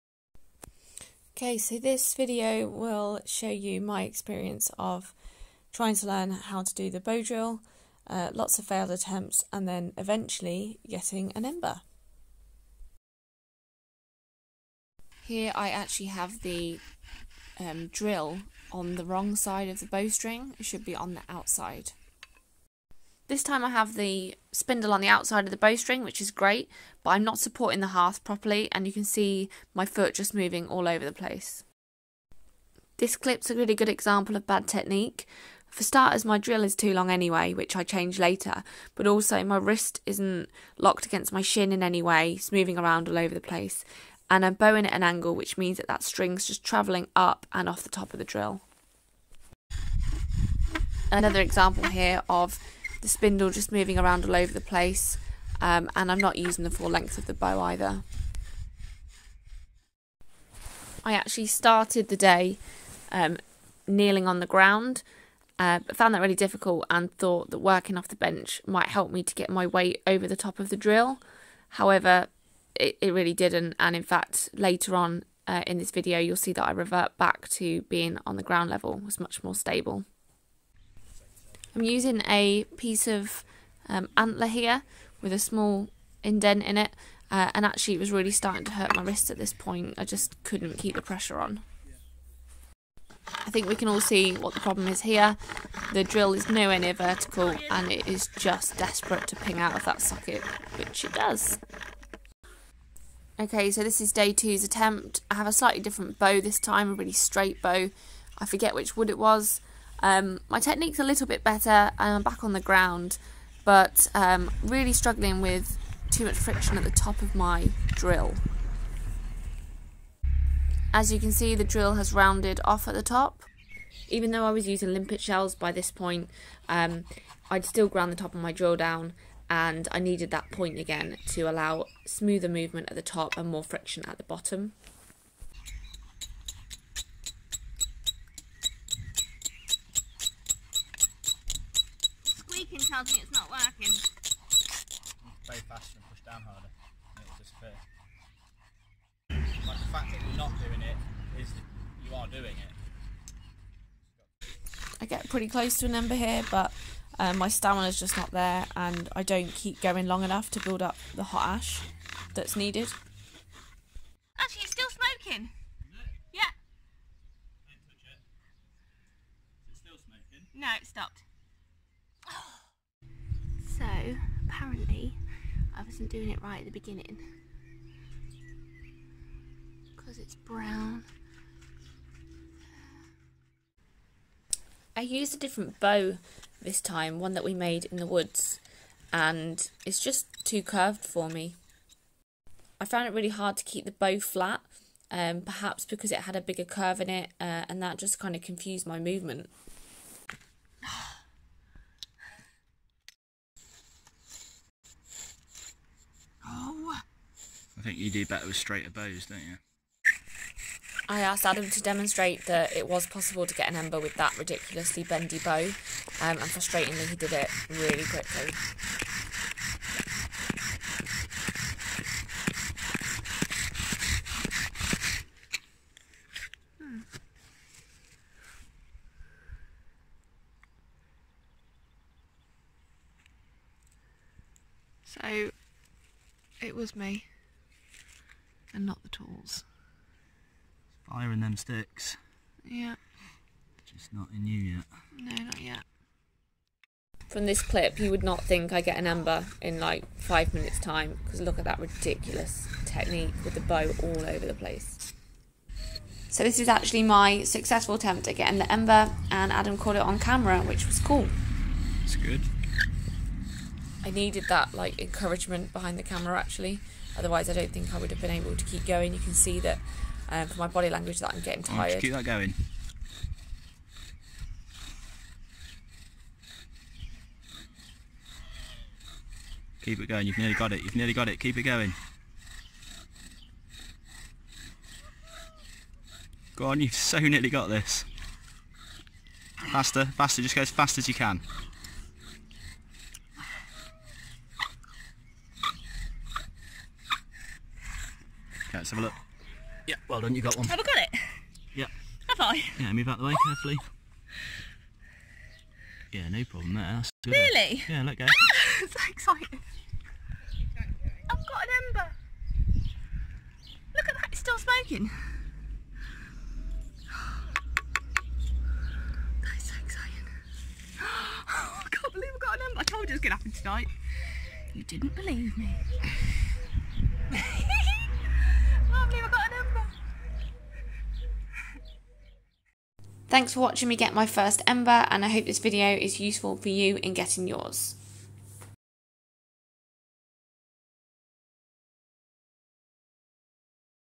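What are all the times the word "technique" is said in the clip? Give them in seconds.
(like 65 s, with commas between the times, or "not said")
34 s, 110 s, 252 s.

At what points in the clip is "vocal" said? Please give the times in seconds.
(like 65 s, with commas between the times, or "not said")
not said.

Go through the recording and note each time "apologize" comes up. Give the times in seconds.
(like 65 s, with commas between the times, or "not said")
not said.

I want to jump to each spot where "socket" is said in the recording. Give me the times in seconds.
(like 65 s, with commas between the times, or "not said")
100 s.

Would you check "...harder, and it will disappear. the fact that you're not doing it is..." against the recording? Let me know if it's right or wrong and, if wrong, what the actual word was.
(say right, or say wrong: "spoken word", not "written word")
right.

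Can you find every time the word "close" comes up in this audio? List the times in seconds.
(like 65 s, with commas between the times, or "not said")
155 s.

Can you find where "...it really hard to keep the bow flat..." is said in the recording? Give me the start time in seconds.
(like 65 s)
193 s.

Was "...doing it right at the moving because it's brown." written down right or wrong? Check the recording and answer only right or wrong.
wrong.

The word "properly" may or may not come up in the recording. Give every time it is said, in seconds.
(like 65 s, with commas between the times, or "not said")
28 s.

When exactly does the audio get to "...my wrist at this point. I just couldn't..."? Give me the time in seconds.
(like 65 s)
88 s.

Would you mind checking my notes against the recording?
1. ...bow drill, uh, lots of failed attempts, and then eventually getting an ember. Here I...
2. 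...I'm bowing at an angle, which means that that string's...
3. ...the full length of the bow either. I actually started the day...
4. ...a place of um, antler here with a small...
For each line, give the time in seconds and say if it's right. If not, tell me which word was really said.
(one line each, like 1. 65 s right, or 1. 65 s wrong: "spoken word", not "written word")
1. 6 s right
2. 44 s right
3. 56 s right
4. 82 s wrong: "piece", not "place".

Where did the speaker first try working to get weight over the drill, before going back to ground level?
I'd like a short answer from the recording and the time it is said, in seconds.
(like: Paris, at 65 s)
the bench, at 68 s.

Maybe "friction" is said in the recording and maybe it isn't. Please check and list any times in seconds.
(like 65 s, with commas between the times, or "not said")
116 s, 133 s.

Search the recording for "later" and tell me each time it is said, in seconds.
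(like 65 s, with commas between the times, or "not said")
38 s, 74 s.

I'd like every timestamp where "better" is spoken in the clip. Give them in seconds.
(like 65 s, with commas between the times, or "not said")
111 s, 208 s.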